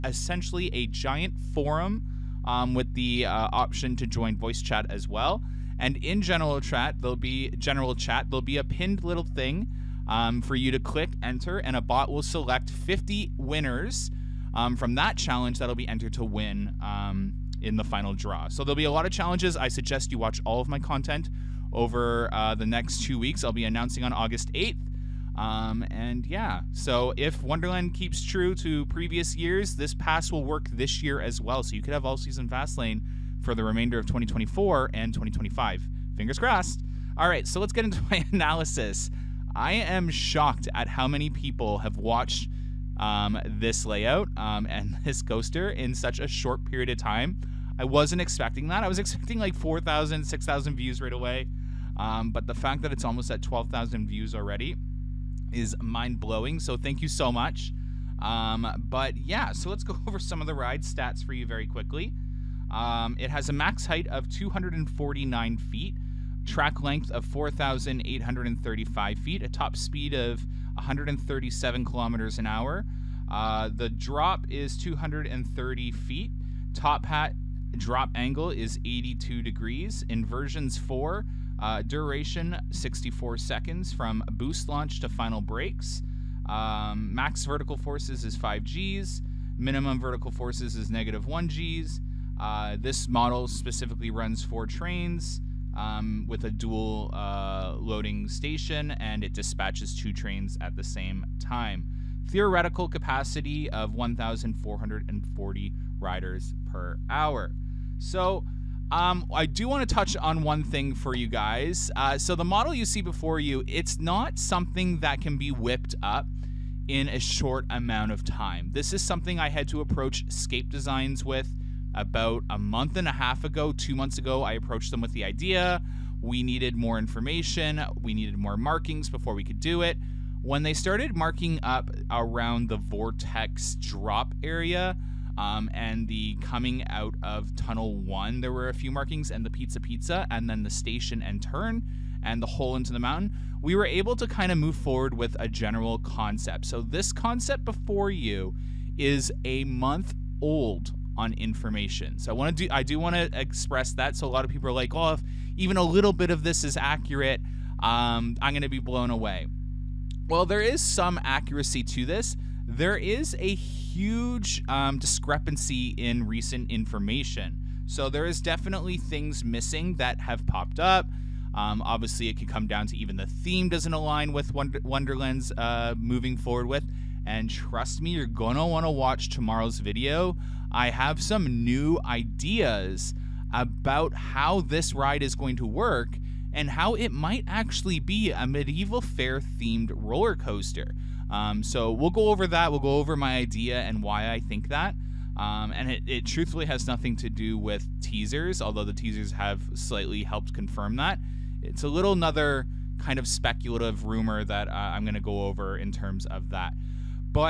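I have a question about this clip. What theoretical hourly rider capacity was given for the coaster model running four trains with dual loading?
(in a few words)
1,440 riders per hour.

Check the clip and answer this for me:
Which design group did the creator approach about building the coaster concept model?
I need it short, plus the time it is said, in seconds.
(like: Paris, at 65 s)
Scape Designs, at 120 s.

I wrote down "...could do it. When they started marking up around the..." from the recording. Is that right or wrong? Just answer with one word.
right.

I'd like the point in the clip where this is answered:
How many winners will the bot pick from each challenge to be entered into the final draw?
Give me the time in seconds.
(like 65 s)
12 s.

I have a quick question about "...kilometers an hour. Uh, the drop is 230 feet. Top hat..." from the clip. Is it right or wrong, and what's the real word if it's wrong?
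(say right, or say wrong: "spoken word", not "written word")
right.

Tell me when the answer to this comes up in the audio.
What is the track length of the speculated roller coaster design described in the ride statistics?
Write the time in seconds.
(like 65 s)
67 s.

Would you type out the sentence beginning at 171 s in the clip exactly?
Um, obviously, it can come down to even the theme doesn't align with Wonder- Wonderland's uh, moving forward with.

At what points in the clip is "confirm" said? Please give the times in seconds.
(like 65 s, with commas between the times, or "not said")
200 s.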